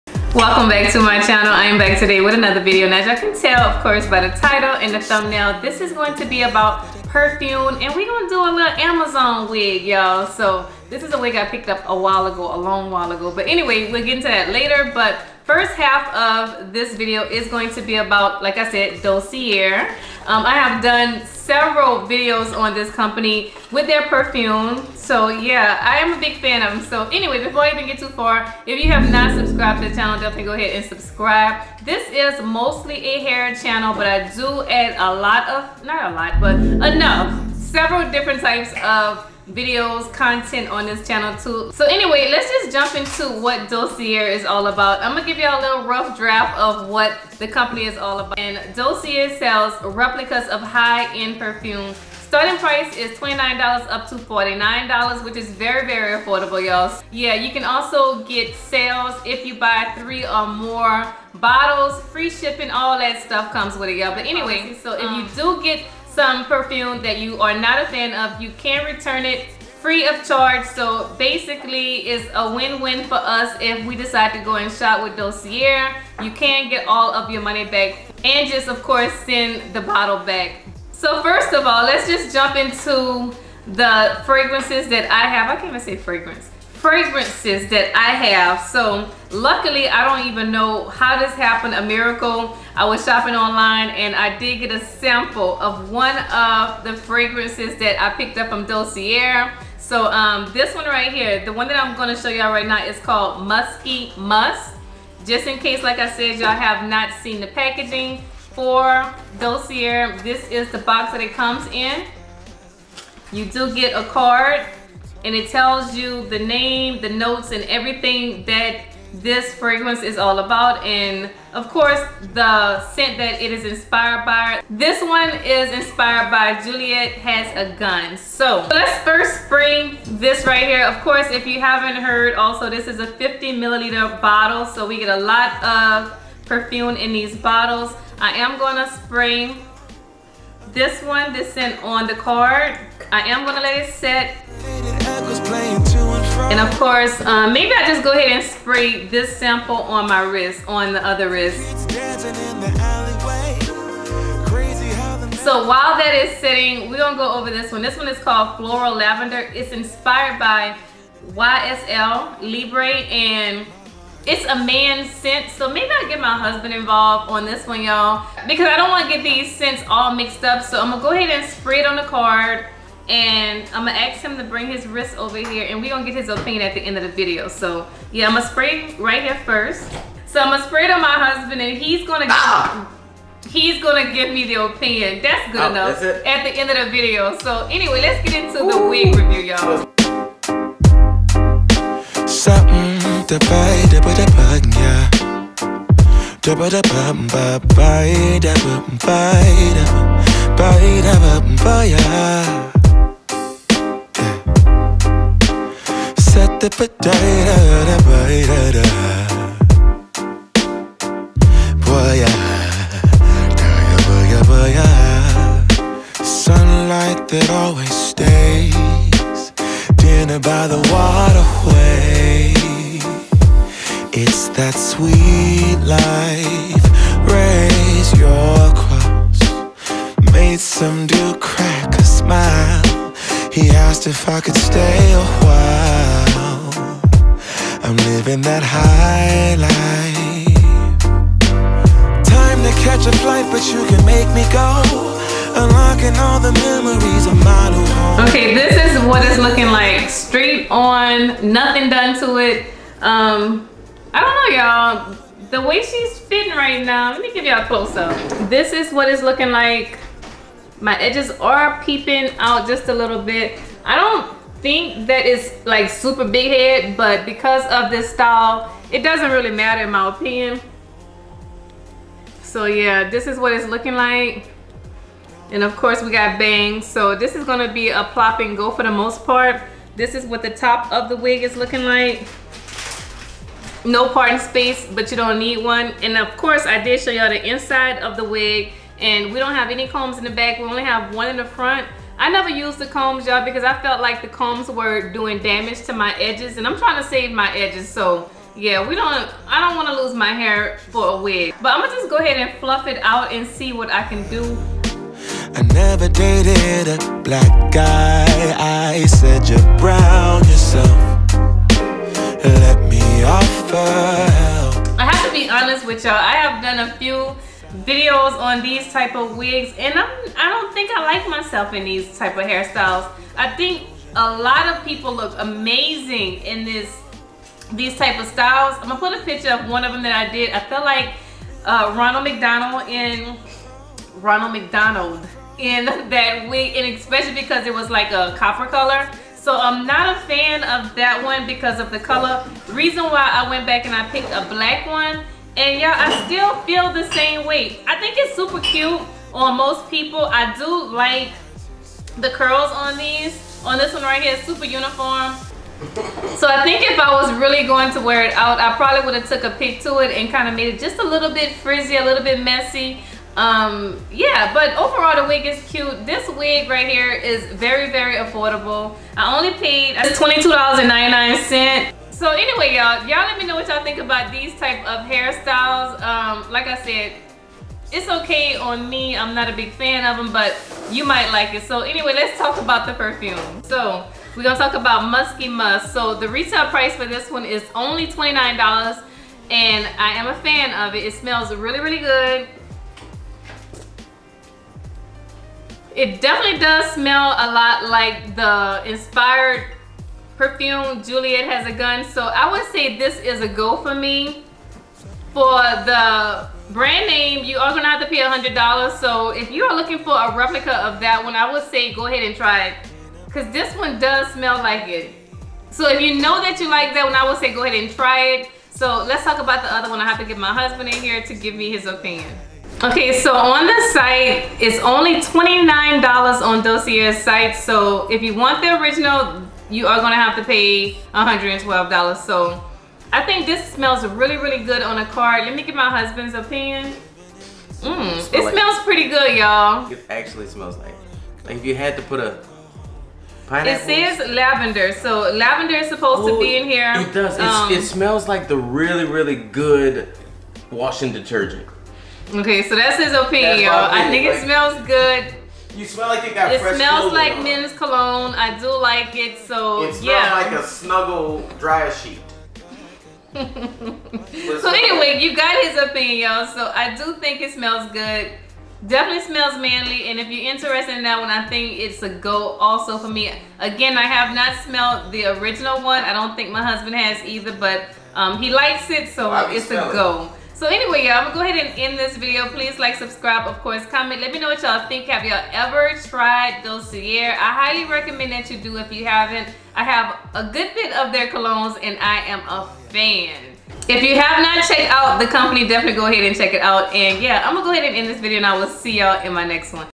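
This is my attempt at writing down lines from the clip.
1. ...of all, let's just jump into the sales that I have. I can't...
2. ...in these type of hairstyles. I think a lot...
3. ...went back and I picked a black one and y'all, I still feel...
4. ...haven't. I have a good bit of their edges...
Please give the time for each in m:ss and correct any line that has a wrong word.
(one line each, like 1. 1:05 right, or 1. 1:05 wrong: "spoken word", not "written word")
1. 1:21 wrong: "fragrances", not "sales"
2. 5:21 right
3. 5:43 right
4. 8:09 wrong: "colognes", not "edges".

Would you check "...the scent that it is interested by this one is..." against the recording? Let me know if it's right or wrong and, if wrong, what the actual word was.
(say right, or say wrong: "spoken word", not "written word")
wrong: "inspired", not "interested".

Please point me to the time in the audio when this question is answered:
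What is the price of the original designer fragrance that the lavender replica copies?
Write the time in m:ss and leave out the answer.
7:11.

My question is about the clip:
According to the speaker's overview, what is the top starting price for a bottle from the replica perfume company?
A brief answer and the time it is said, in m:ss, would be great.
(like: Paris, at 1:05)
$49, at 0:54.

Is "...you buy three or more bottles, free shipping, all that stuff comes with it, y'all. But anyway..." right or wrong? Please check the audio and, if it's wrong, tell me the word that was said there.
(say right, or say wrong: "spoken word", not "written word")
right.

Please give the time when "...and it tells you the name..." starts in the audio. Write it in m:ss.
1:55.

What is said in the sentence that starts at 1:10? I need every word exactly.
So basically it's a win-win for us if we decide to go and shop with Dossier.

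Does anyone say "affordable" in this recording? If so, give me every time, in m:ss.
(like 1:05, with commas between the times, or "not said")
0:56, 6:08.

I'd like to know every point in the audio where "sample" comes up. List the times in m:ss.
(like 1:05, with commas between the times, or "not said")
1:34, 2:29.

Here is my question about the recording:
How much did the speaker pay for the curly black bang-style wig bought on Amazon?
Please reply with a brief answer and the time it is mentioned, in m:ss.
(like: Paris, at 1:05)
$22.99, at 6:09.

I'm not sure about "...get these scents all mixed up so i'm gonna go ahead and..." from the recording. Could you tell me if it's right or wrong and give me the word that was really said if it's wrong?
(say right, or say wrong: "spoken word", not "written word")
right.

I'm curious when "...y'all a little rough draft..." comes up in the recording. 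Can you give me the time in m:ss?
0:45.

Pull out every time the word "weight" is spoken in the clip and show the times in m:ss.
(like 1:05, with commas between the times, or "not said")
5:47.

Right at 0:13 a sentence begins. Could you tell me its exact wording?
But anyway, we'll get into that later.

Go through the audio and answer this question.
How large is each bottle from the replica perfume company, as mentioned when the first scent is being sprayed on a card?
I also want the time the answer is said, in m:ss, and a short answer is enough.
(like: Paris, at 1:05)
50 milliliters, at 2:13.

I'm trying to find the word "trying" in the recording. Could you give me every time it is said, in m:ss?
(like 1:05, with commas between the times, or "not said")
4:56.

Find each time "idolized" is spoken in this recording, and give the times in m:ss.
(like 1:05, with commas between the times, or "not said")
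not said.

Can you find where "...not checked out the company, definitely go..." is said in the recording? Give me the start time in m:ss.
8:14.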